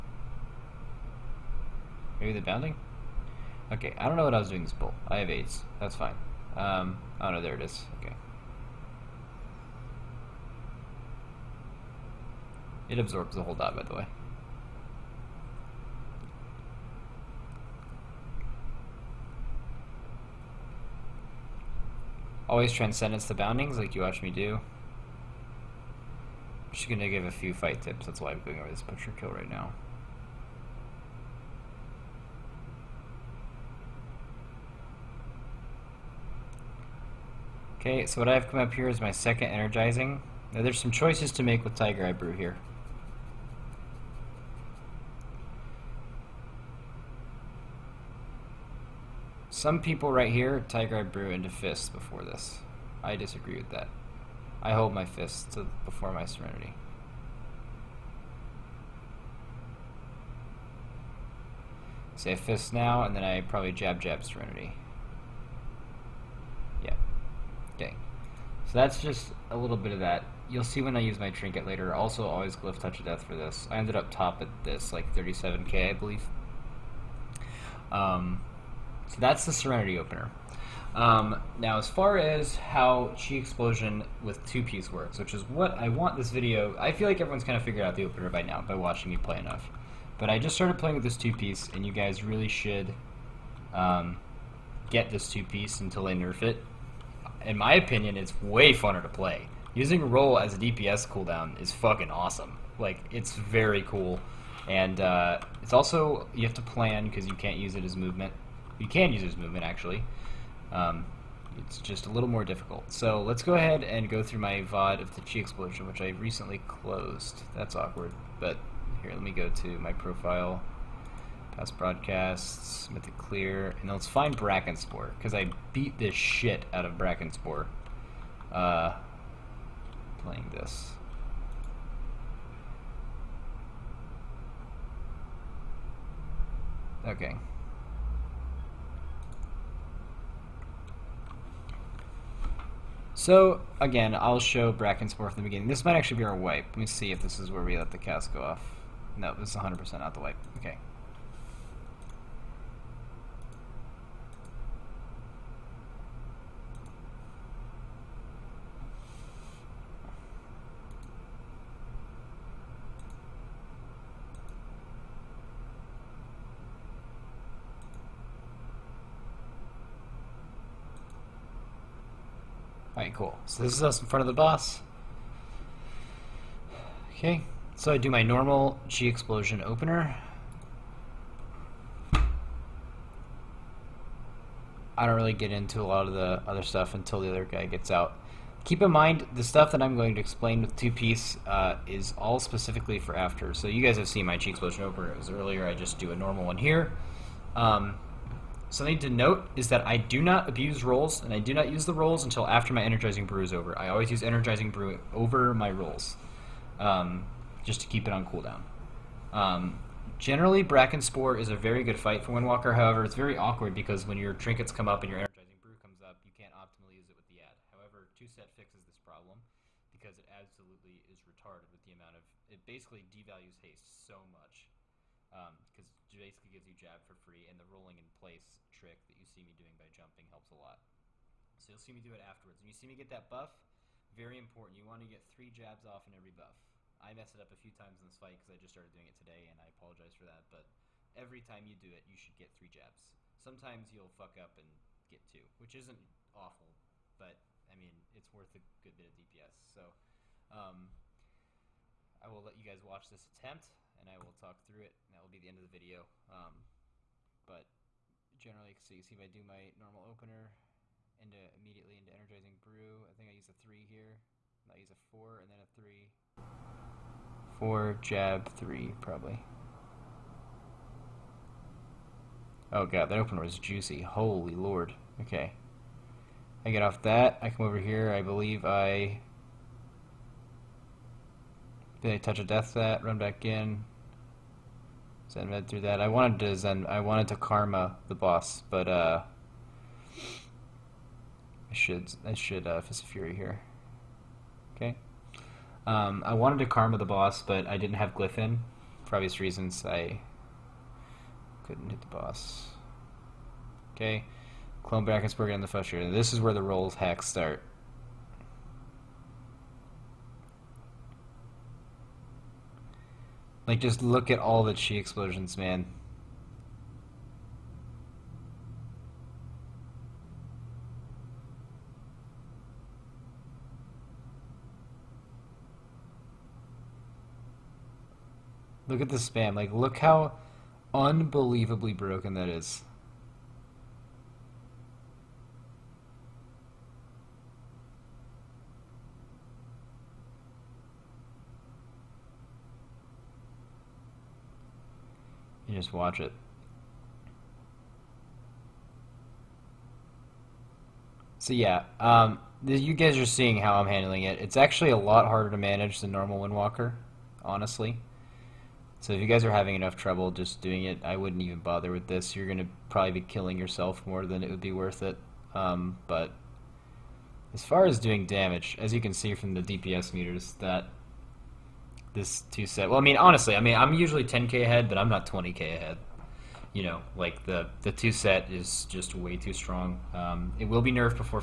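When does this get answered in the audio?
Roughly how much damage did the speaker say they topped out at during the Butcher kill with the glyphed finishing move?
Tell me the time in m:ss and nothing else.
1:15.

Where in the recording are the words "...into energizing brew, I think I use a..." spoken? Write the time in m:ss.
4:21.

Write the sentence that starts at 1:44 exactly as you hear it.
And uh, it's also, you have to plan because you can't use it as movement.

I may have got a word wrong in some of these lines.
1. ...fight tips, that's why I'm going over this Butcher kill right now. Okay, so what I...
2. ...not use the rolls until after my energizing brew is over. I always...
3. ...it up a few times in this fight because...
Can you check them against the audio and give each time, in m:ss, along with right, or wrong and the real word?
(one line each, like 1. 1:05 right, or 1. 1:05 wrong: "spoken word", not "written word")
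1. 0:27 right
2. 3:21 right
3. 3:57 right.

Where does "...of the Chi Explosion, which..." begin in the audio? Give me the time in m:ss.
1:55.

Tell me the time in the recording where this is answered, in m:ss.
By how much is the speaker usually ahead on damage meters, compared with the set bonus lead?
6:14.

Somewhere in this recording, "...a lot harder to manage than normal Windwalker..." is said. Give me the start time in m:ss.
5:54.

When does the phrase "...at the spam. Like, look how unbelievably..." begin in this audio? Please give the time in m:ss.
5:28.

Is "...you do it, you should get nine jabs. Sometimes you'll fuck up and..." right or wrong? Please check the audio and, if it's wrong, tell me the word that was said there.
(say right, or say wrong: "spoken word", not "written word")
wrong: "three", not "nine".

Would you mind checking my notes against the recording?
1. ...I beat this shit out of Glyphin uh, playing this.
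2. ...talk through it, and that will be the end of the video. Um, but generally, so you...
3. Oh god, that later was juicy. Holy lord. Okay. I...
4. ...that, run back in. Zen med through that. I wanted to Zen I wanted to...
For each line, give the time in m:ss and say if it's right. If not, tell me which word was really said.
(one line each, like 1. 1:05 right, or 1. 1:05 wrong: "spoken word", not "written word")
1. 2:05 wrong: "Brackenspore", not "Glyphin"
2. 4:14 right
3. 4:32 wrong: "opener", not "later"
4. 4:42 right.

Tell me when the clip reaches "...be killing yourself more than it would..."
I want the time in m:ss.
6:03.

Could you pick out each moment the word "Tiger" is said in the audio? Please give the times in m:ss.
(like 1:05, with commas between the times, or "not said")
0:41, 0:50.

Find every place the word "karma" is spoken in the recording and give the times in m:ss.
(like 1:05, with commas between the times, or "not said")
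4:47, 4:56.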